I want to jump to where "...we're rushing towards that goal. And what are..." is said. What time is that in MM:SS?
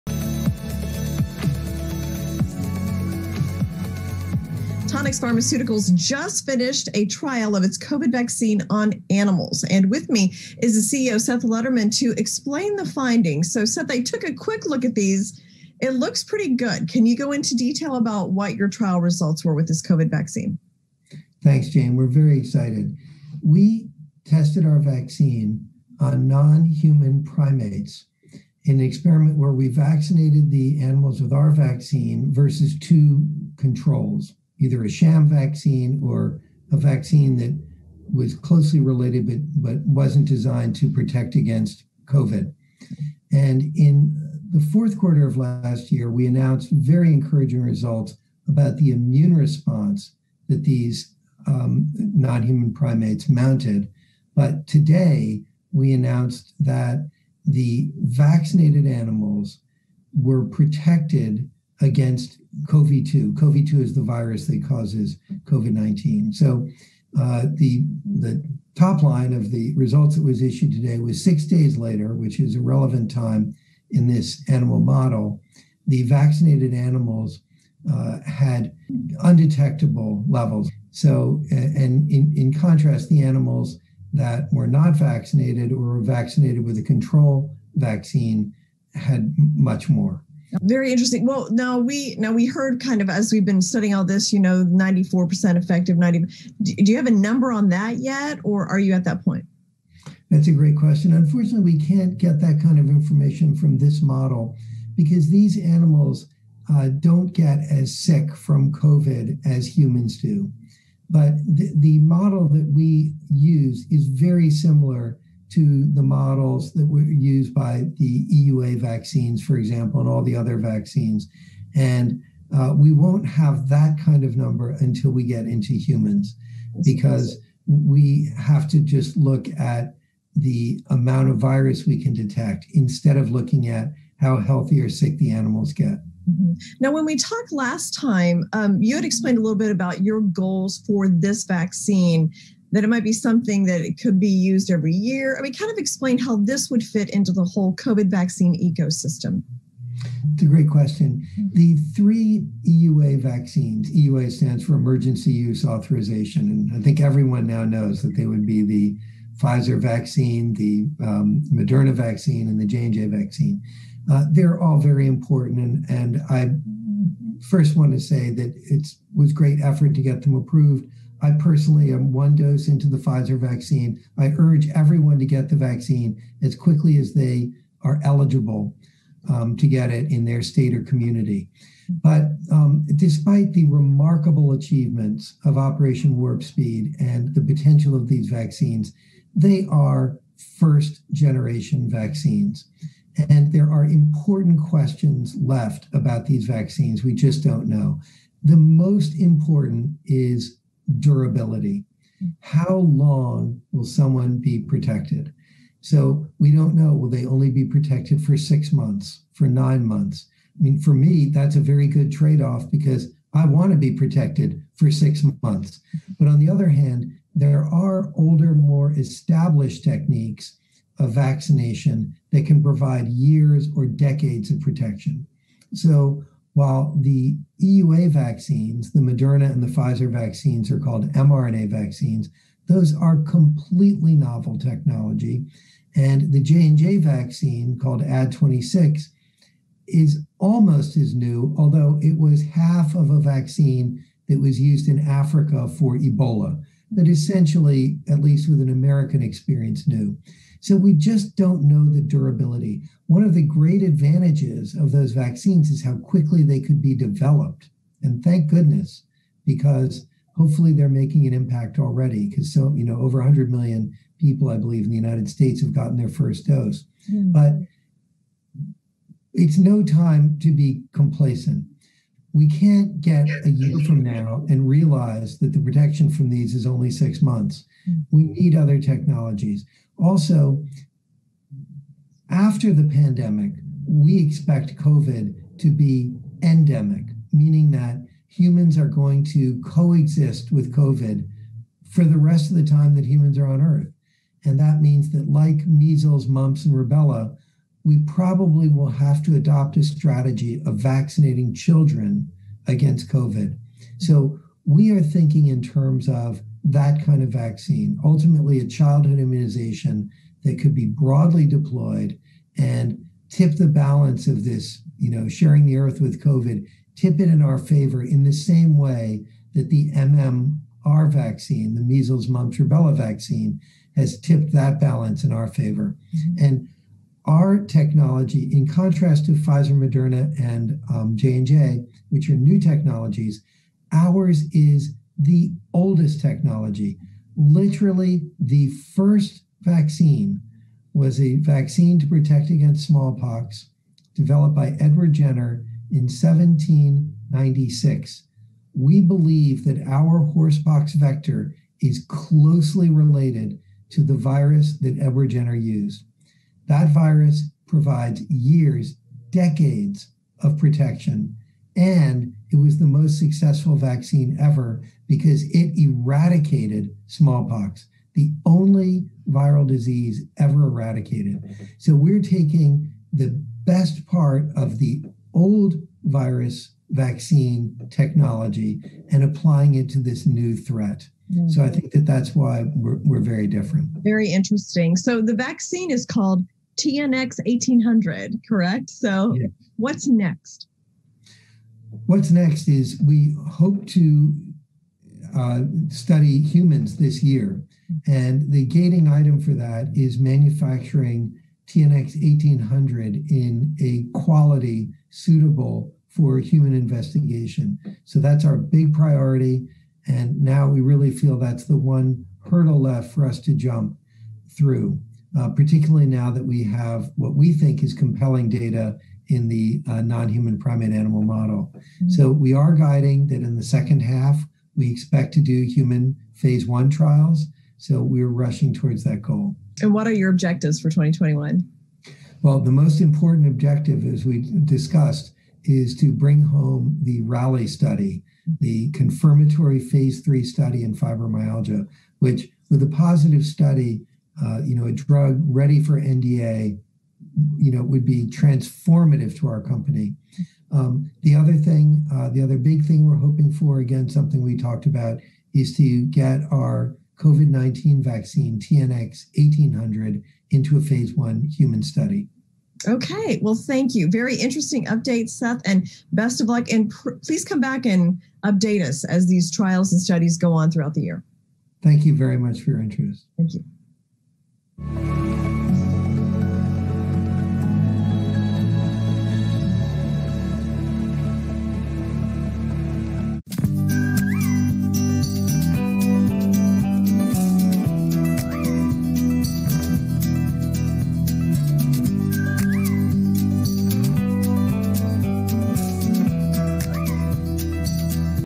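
07:08.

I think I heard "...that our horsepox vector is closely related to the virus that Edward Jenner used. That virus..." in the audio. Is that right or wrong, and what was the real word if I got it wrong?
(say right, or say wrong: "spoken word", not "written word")
right.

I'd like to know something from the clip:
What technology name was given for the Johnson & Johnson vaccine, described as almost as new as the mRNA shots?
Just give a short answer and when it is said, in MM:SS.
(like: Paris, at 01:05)
Ad26, at 03:58.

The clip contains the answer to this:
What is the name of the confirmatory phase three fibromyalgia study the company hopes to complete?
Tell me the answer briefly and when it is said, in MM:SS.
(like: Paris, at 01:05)
RALLY, at 07:17.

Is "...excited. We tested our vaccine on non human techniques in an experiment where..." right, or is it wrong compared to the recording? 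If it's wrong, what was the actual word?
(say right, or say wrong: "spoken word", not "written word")
wrong: "primates", not "techniques".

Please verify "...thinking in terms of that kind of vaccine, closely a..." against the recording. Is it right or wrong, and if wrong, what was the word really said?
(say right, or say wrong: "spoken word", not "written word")
wrong: "ultimately", not "closely".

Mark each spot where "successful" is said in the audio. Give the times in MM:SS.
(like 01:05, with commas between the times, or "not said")
06:03.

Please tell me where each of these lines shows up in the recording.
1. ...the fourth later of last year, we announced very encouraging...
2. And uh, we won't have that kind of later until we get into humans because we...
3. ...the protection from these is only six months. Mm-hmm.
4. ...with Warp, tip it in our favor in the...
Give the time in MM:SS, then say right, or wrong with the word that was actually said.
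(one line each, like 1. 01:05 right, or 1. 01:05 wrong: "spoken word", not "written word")
1. 00:44 wrong: "quarter", not "later"
2. 02:01 wrong: "number", not "later"
3. 04:35 right
4. 05:15 wrong: "COVID", not "Warp".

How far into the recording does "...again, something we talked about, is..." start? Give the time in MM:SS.
07:33.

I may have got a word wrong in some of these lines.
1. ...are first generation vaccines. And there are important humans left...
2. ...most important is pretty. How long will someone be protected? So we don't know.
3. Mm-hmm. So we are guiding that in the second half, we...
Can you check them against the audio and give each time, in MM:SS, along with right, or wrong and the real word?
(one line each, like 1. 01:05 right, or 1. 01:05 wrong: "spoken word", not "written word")
1. 03:09 wrong: "questions", not "humans"
2. 03:18 wrong: "durability", not "pretty"
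3. 07:01 right.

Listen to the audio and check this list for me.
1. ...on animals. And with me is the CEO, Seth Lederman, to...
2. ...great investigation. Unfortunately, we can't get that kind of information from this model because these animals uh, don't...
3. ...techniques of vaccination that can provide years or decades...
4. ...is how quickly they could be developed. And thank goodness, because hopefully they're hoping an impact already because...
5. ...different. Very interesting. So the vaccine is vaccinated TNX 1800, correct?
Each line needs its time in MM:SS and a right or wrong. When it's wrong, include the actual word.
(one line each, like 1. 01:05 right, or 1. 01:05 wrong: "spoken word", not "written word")
1. 00:08 right
2. 01:40 wrong: "question", not "investigation"
3. 03:39 right
4. 04:15 wrong: "making", not "hoping"
5. 06:23 wrong: "called", not "vaccinated".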